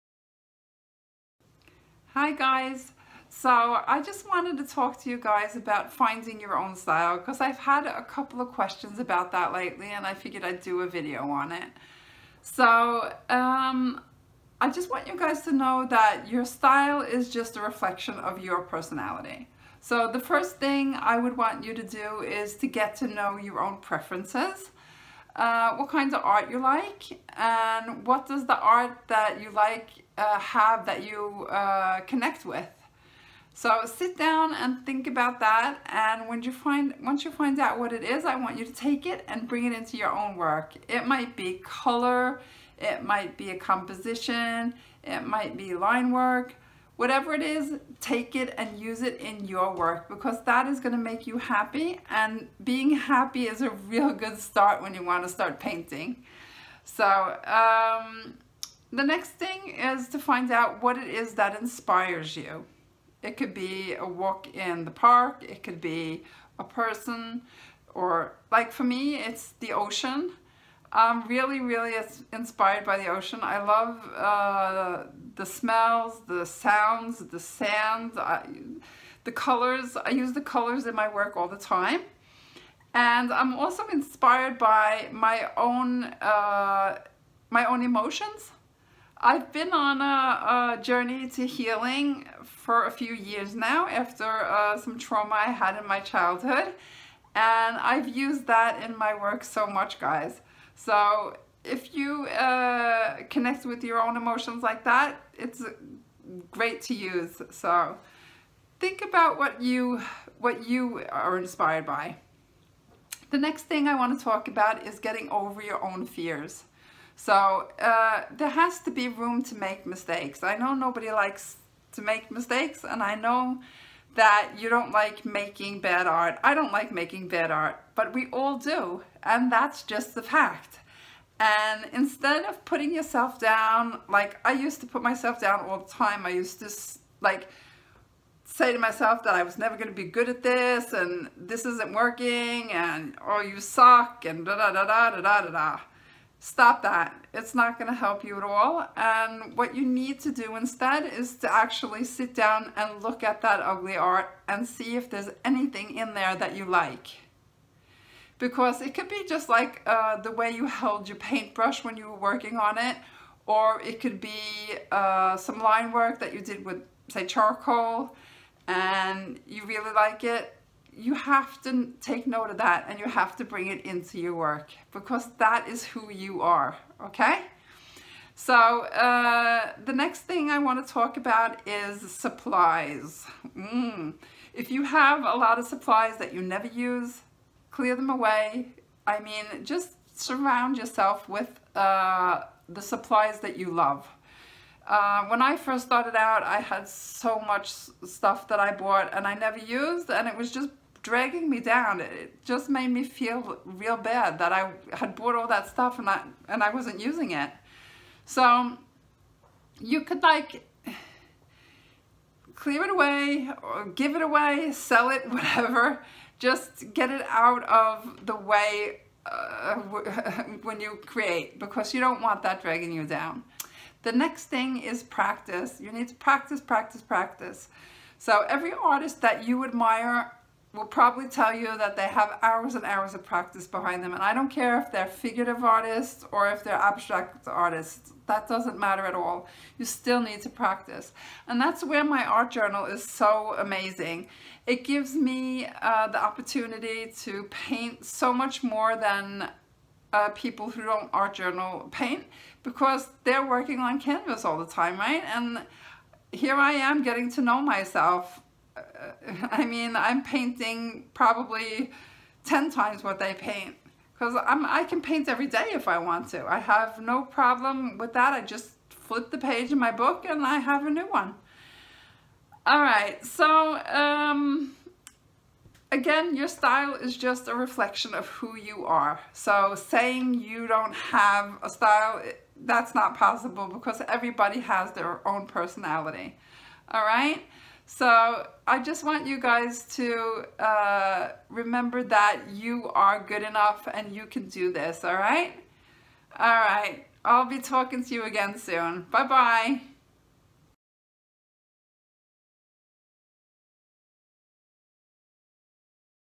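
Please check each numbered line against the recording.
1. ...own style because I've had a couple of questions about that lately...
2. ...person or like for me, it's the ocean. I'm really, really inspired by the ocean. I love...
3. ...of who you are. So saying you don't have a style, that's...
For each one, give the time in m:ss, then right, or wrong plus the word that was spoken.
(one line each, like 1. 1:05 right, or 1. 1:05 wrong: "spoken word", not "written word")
1. 0:06 right
2. 1:06 right
3. 4:38 right.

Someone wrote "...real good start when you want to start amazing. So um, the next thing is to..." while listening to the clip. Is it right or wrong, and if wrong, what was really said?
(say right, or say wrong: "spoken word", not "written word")
wrong: "painting", not "amazing".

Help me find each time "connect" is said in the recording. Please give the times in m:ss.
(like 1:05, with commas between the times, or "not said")
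0:32, 1:43.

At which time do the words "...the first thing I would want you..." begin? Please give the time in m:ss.
0:20.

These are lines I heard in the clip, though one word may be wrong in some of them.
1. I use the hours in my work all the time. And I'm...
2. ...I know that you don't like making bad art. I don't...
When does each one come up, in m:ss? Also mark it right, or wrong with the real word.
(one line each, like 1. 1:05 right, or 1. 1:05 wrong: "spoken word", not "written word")
1. 1:19 wrong: "colors", not "hours"
2. 2:03 right.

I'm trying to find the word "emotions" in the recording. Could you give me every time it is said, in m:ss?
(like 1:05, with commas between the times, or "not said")
1:27, 1:44.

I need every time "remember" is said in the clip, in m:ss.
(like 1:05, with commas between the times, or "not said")
4:51.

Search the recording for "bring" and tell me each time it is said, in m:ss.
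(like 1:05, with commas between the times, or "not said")
0:39, 2:53.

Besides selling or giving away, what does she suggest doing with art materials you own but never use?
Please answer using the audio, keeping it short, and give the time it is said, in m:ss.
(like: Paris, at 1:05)
Clear them away, at 3:07.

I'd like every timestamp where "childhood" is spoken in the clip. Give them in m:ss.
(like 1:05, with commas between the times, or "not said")
1:36.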